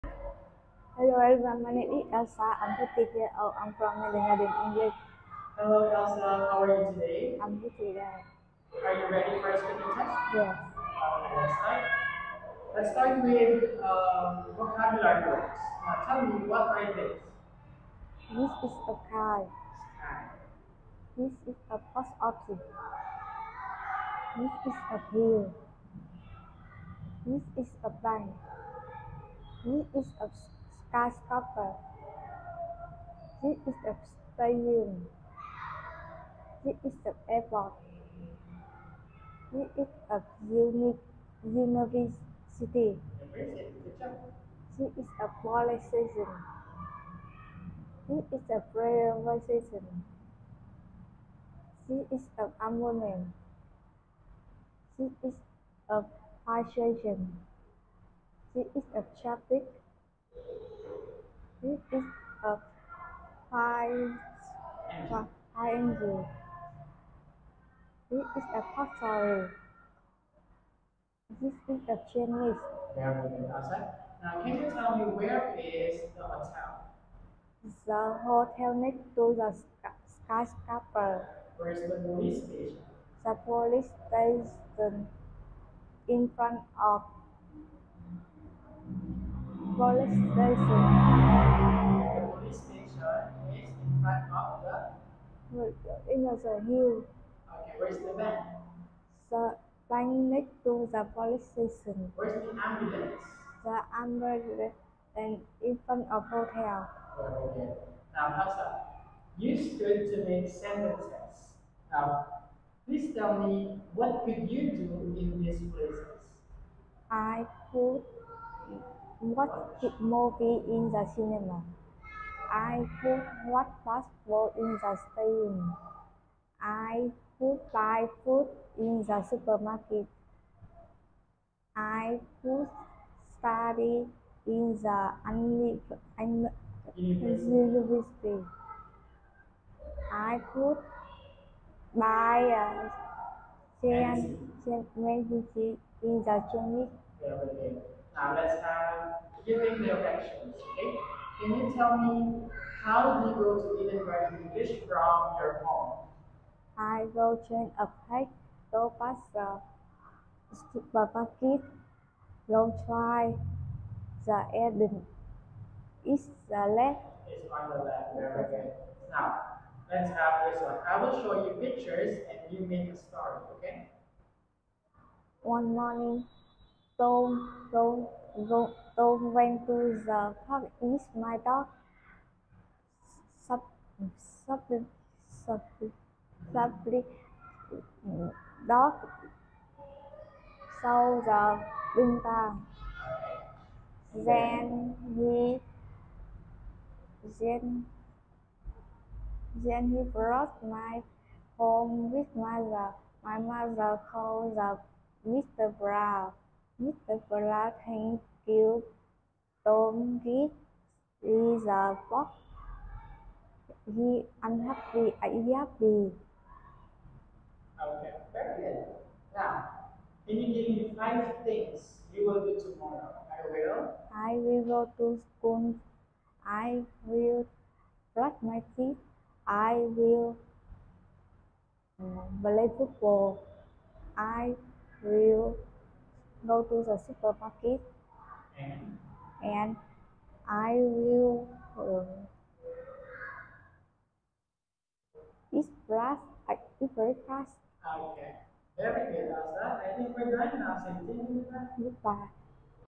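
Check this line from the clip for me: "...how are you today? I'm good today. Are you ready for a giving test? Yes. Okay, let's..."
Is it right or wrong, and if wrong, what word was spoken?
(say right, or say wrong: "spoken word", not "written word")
wrong: "speaking", not "giving".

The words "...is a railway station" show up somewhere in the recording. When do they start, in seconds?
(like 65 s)
48 s.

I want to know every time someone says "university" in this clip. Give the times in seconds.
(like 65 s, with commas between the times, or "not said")
41 s, 136 s.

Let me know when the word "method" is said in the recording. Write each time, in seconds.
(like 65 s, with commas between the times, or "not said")
not said.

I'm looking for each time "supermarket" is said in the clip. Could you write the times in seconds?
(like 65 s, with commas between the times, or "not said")
129 s, 160 s, 237 s.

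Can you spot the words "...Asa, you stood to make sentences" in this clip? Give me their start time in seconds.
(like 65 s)
108 s.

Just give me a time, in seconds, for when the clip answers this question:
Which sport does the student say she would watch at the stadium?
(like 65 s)
123 s.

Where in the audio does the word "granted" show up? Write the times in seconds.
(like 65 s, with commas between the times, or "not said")
not said.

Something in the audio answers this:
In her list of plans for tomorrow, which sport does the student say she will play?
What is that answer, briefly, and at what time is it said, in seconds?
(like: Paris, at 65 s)
football, at 232 s.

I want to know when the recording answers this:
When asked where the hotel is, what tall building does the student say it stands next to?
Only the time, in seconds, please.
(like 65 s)
80 s.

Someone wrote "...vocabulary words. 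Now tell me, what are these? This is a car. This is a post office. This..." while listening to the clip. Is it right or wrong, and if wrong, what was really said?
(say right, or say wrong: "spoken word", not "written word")
right.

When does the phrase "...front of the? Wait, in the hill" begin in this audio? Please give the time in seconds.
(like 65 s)
94 s.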